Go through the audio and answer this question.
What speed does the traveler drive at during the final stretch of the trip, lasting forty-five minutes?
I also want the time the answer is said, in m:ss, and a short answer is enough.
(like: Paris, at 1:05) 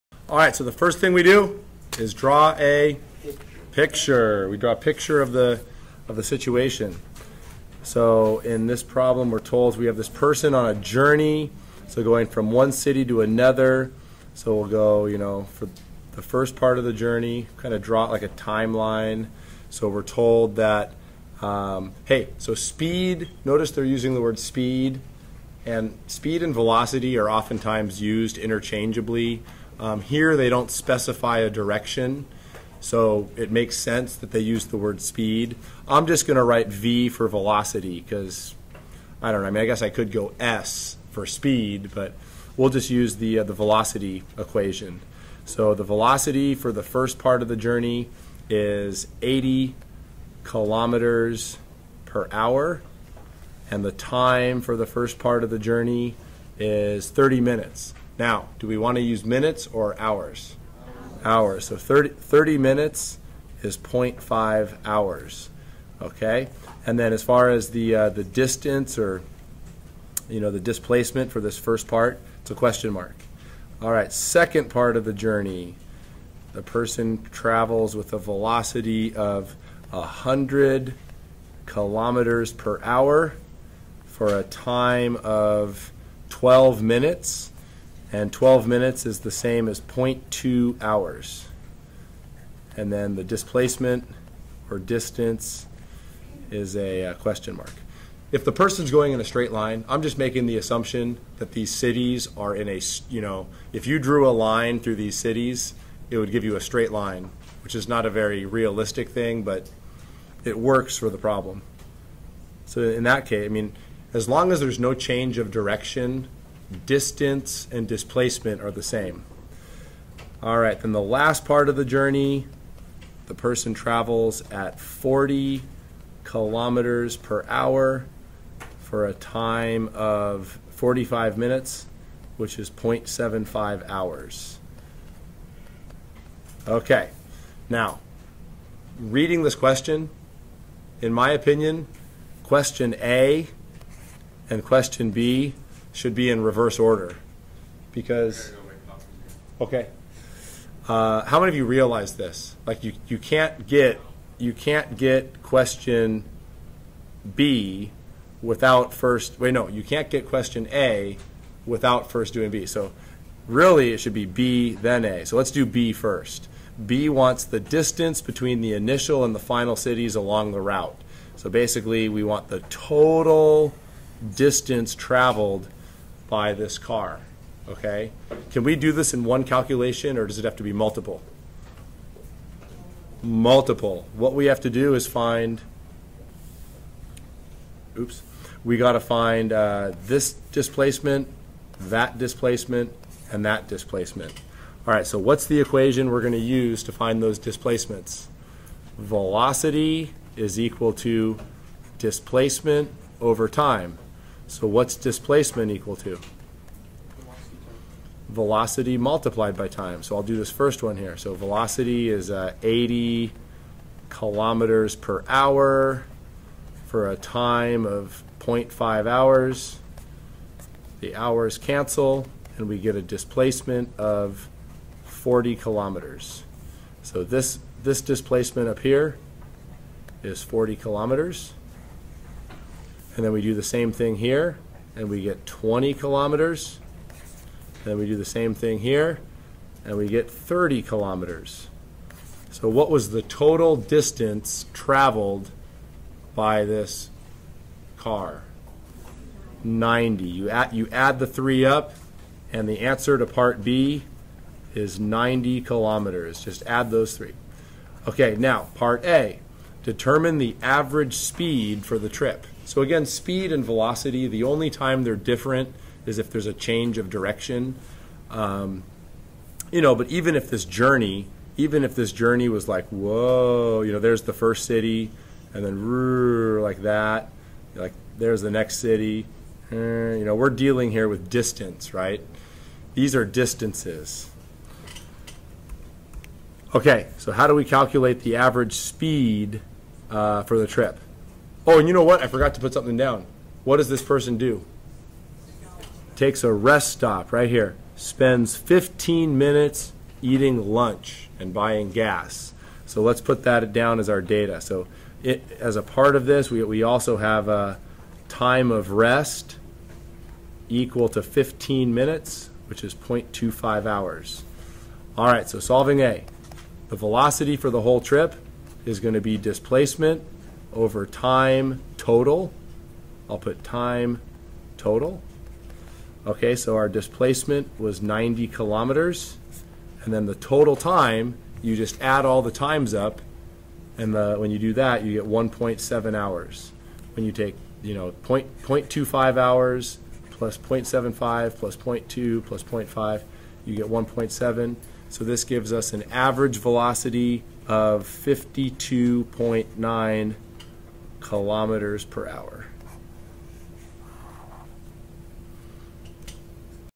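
40 kilometers per hour, at 2:04.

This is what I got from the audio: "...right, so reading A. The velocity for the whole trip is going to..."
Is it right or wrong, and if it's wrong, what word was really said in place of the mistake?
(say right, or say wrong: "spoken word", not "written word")
wrong: "solving", not "reading".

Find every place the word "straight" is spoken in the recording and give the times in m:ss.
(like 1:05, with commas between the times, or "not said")
1:39, 1:46.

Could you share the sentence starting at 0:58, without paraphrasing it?
Now, do we want to use minutes or hours?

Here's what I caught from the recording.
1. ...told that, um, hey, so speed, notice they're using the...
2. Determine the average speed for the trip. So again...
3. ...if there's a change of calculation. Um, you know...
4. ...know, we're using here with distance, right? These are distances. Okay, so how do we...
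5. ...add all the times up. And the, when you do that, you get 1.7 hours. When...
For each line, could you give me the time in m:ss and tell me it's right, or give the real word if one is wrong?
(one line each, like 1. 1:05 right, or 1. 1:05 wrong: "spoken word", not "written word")
1. 0:20 right
2. 4:19 right
3. 4:26 wrong: "direction", not "calculation"
4. 4:40 wrong: "dealing", not "using"
5. 5:32 right.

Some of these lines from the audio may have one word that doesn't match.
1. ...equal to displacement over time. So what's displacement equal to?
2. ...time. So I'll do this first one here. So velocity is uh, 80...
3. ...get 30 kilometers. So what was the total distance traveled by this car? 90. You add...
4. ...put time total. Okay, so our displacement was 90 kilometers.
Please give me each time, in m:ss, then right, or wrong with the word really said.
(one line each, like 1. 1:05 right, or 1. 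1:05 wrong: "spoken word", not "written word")
1. 3:20 right
2. 3:29 right
3. 4:00 right
4. 5:23 right.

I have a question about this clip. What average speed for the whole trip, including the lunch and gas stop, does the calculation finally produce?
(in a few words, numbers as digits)
52.9 kilometers per hour.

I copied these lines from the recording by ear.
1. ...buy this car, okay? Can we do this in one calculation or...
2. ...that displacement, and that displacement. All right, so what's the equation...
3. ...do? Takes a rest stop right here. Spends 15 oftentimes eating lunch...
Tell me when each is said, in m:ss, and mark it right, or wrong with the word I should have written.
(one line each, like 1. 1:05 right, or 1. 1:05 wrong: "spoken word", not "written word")
1. 2:56 right
2. 3:11 right
3. 4:54 wrong: "minutes", not "oftentimes".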